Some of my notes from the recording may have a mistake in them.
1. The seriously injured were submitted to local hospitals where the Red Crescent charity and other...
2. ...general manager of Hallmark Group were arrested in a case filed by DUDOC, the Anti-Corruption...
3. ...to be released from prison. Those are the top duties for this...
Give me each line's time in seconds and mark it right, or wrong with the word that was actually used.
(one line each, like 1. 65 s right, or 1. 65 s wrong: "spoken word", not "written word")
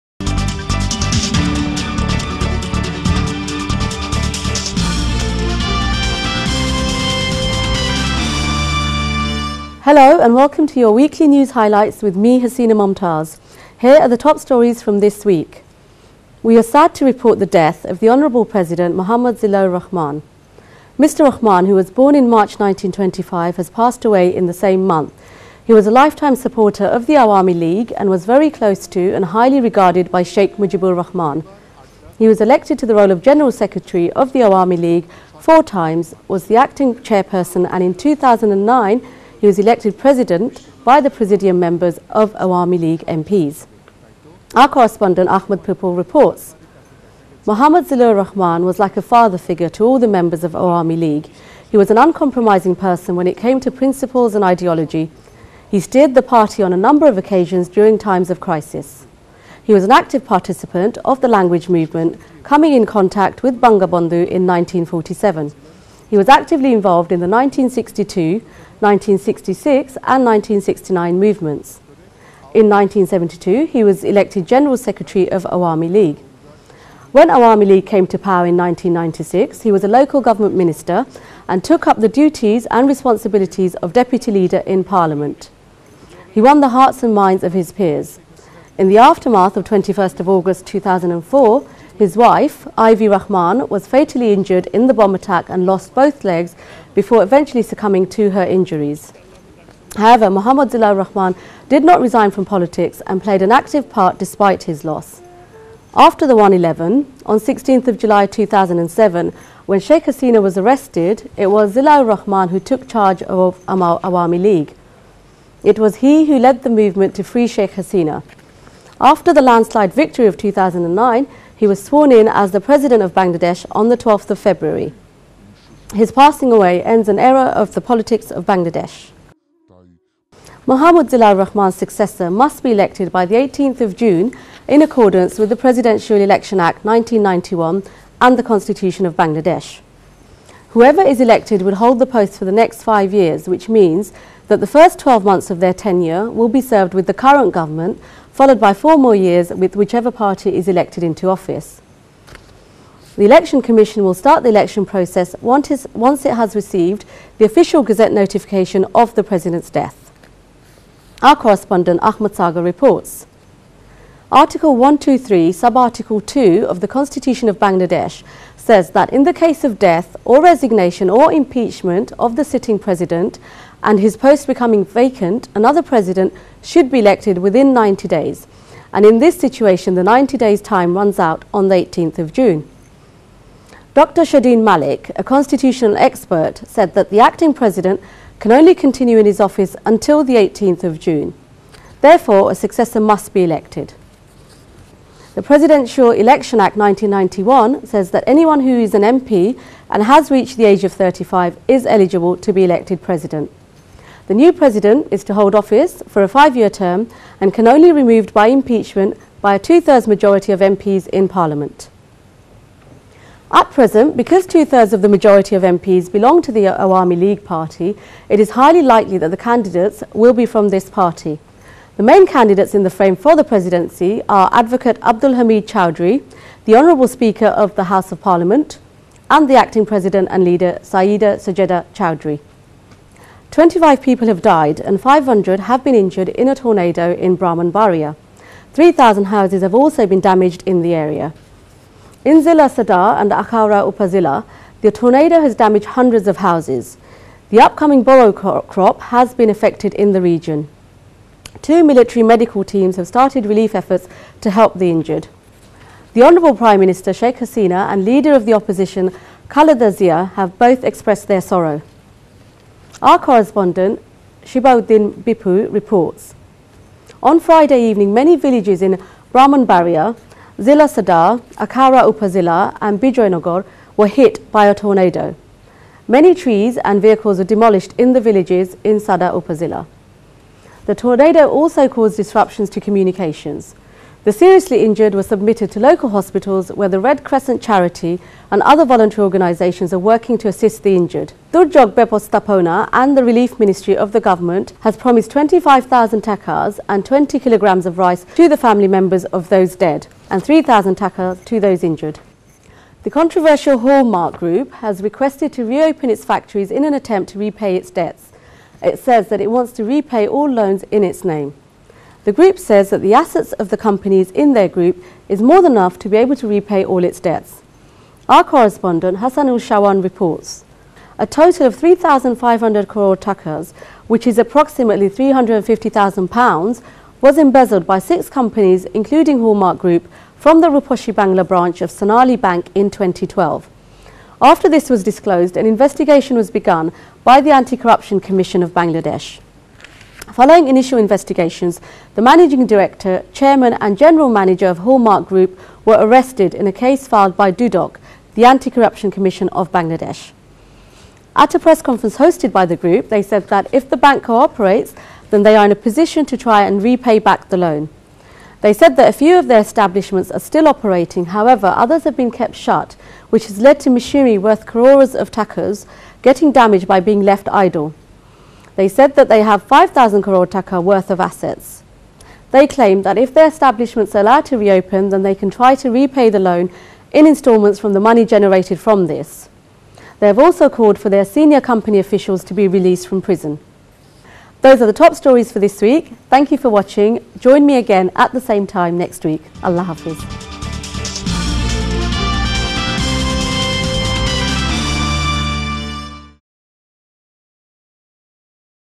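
1. 284 s right
2. 343 s right
3. 382 s wrong: "stories", not "duties".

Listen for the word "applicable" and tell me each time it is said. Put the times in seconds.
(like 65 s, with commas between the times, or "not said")
not said.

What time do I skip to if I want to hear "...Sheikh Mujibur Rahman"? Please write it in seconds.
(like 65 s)
30 s.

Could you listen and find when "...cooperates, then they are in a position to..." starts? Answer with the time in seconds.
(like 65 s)
354 s.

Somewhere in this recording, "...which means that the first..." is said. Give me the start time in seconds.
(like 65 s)
143 s.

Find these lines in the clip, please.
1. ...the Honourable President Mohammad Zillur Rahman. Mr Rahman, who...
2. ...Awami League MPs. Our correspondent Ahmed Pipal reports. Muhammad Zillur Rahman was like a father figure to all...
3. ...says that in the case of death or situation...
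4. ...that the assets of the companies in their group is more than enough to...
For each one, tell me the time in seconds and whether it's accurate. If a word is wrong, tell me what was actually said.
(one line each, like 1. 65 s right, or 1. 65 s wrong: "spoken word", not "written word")
1. 17 s right
2. 42 s right
3. 168 s wrong: "resignation", not "situation"
4. 312 s right.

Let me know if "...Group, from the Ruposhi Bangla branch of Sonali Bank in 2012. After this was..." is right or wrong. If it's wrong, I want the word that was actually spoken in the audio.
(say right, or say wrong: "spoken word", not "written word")
right.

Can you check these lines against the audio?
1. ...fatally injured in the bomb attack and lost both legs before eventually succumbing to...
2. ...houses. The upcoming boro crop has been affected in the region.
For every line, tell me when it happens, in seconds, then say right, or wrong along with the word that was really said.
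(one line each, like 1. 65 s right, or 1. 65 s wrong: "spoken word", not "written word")
1. 93 s right
2. 246 s right.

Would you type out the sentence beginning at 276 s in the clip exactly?
Many trees and vehicles were demolished in the villages in Sadar Upazilla.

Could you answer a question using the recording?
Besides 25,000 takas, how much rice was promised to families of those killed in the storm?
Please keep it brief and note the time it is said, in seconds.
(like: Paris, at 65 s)
20 kilograms, at 297 s.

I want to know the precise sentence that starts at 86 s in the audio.
He won the hearts and minds of his peers.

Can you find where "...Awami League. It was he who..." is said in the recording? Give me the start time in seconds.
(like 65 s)
113 s.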